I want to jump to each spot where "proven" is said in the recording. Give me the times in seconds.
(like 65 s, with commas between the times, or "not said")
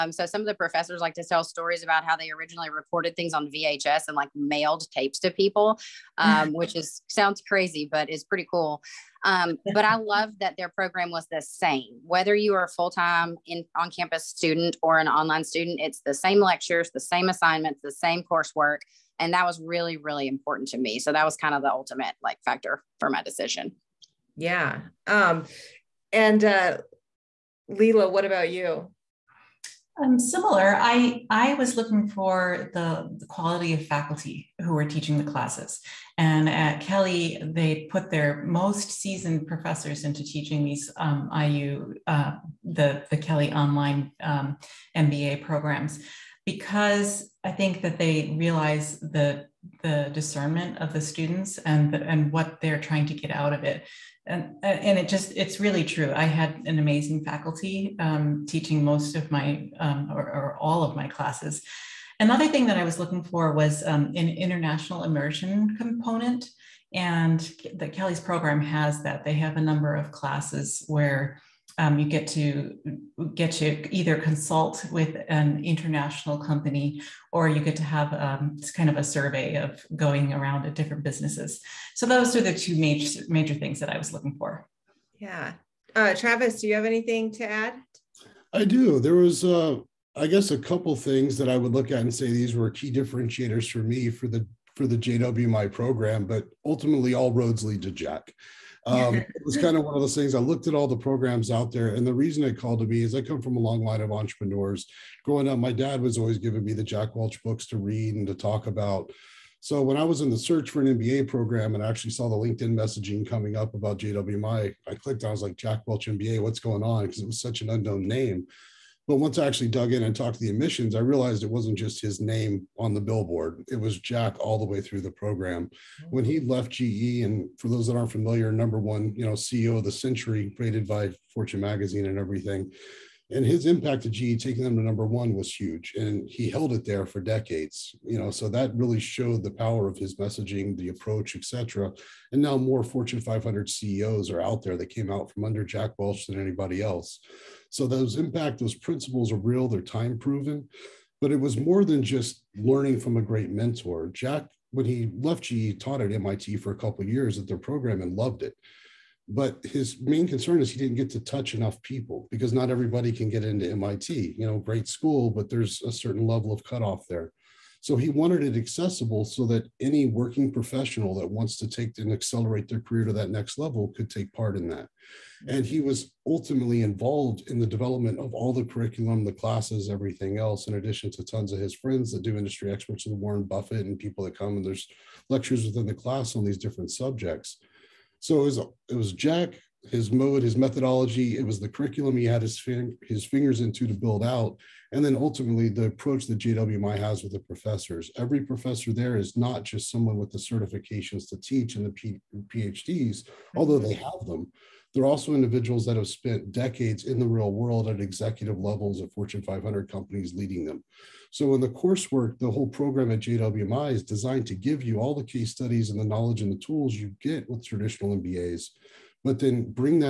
150 s.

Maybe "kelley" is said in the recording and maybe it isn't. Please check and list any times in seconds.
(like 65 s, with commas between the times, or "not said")
36 s, 43 s, 67 s.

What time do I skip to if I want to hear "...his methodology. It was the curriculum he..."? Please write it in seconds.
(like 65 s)
190 s.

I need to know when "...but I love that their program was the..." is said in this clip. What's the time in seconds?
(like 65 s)
9 s.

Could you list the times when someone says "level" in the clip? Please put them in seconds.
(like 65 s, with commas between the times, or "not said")
166 s, 173 s, 208 s.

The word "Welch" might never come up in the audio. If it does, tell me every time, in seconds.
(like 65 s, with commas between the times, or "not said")
107 s, 115 s, 145 s.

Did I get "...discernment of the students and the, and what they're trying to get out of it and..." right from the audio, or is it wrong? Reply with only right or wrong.
right.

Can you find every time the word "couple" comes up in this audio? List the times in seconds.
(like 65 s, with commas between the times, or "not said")
90 s, 156 s.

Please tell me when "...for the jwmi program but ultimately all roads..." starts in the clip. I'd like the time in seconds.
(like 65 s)
94 s.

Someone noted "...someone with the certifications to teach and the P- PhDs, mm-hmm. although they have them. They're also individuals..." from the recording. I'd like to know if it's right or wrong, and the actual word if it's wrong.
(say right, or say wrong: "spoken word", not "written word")
right.